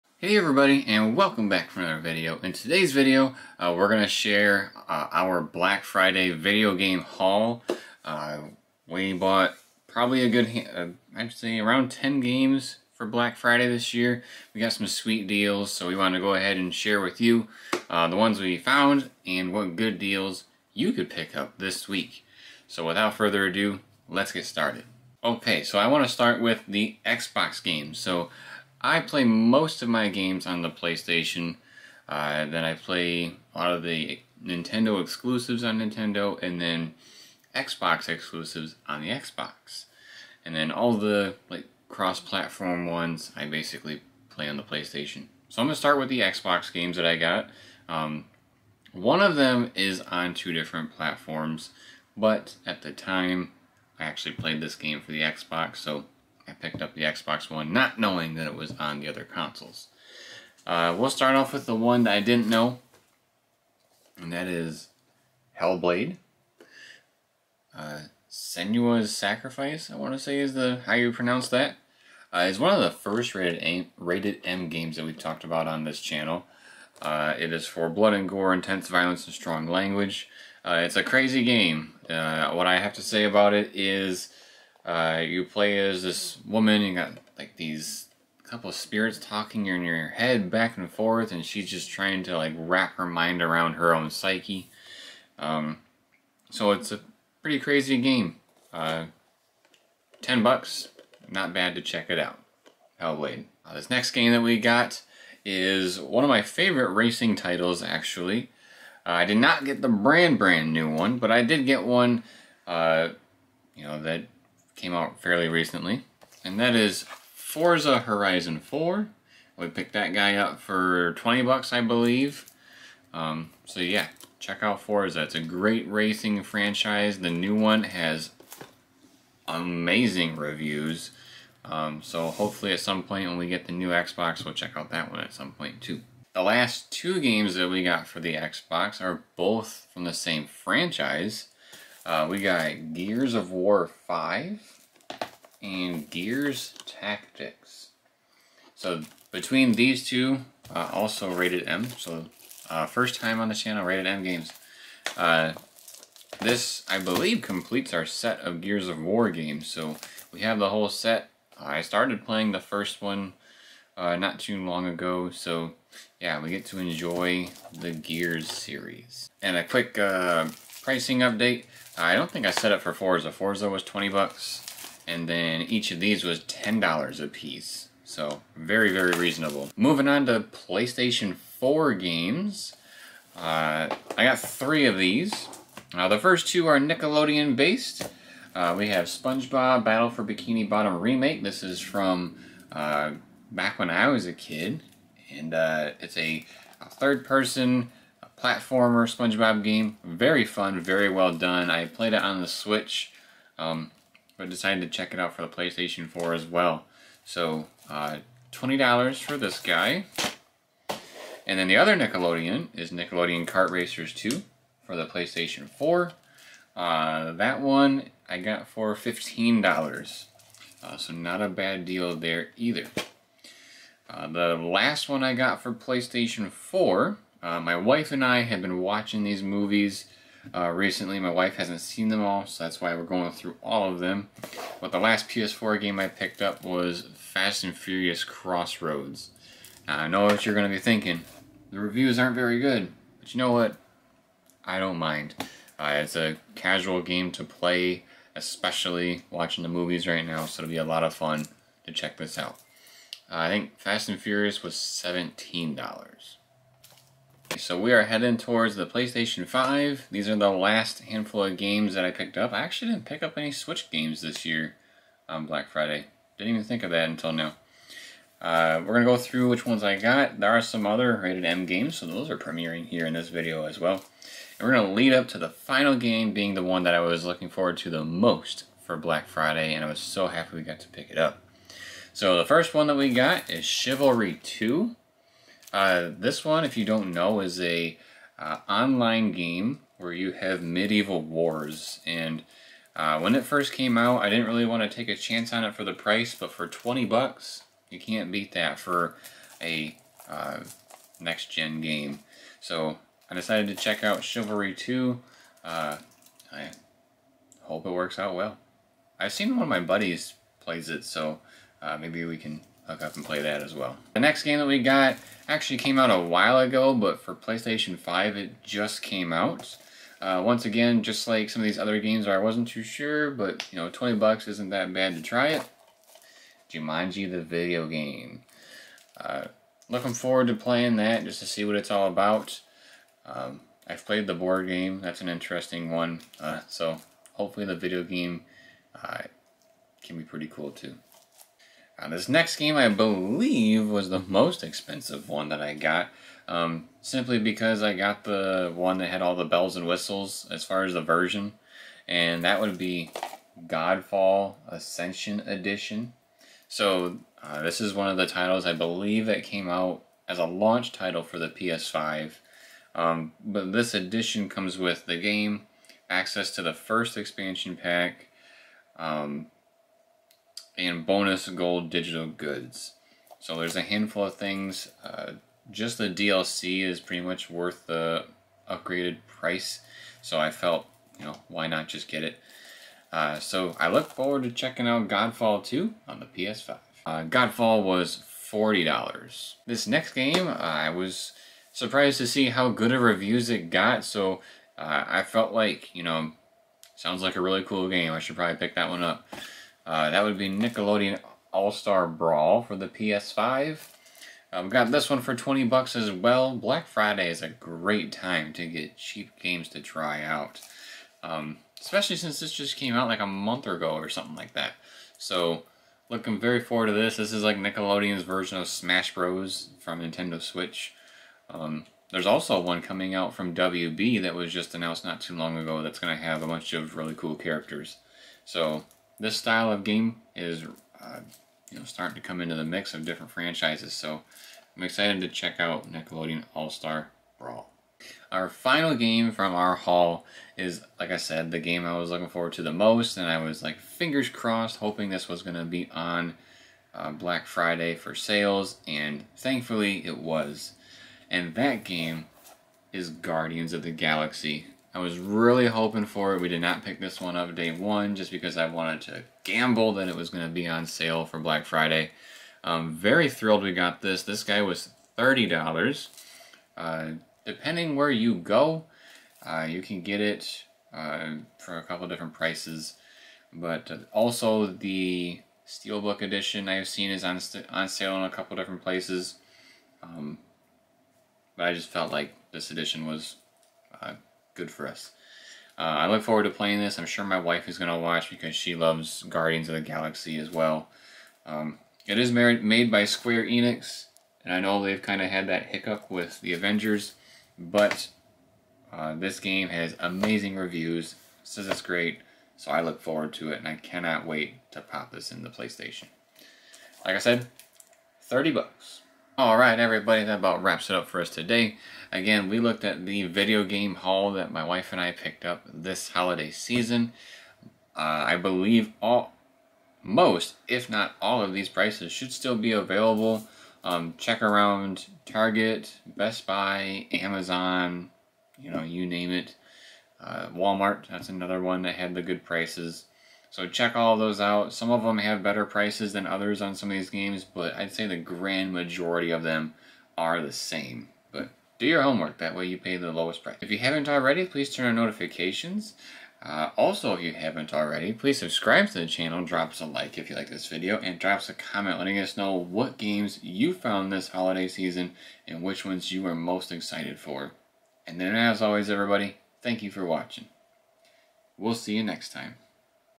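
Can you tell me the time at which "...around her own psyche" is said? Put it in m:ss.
1:33.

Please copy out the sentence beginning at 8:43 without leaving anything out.
Um, check around Target, Best Buy, Amazon, you know, you name it.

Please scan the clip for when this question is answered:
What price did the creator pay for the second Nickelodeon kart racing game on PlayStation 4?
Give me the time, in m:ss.
3:38.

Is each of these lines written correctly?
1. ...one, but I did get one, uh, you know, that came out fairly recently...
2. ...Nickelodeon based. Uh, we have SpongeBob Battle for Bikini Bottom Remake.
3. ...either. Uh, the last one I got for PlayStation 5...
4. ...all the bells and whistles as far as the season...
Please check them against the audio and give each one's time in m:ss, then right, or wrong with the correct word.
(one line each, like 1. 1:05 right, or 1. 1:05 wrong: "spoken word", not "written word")
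1. 1:50 right
2. 3:06 right
3. 3:42 wrong: "4", not "5"
4. 5:49 wrong: "version", not "season".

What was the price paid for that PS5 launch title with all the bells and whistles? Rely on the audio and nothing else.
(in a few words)
$40.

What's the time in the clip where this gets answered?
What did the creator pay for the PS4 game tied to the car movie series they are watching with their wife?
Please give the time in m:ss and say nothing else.
4:14.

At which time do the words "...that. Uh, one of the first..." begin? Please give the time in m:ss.
1:11.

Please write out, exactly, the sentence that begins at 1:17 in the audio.
Uh, it is for blood and gore, intense violence, and strong language.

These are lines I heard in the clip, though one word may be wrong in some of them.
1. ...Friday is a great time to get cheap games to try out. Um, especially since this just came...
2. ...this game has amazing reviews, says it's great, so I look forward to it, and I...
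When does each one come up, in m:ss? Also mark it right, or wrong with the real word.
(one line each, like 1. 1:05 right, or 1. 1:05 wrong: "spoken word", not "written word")
1. 6:46 right
2. 8:19 right.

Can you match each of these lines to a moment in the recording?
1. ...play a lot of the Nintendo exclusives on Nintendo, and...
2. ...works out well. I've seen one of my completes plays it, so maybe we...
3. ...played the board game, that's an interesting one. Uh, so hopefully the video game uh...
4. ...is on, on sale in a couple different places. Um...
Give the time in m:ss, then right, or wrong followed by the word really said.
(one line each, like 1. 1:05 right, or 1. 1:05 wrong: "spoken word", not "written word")
1. 0:32 right
2. 5:07 wrong: "buddies", not "completes"
3. 5:34 right
4. 7:57 right.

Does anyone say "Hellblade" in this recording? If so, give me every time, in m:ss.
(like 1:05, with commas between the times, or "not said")
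1:05, 1:42.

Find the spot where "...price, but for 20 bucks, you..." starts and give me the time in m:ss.
4:55.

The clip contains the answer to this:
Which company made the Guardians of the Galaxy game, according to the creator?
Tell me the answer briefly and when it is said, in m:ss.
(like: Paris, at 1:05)
Square Enix, at 8:13.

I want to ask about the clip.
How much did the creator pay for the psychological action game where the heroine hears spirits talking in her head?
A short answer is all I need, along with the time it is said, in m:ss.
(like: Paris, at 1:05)
$10, at 1:40.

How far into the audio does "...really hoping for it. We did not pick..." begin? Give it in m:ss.
7:35.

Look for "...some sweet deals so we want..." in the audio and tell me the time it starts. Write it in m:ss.
0:14.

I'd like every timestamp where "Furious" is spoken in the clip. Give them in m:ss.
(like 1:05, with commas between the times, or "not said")
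3:57, 4:14.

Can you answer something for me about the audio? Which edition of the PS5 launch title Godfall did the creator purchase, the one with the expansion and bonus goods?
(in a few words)
Ascension Edition.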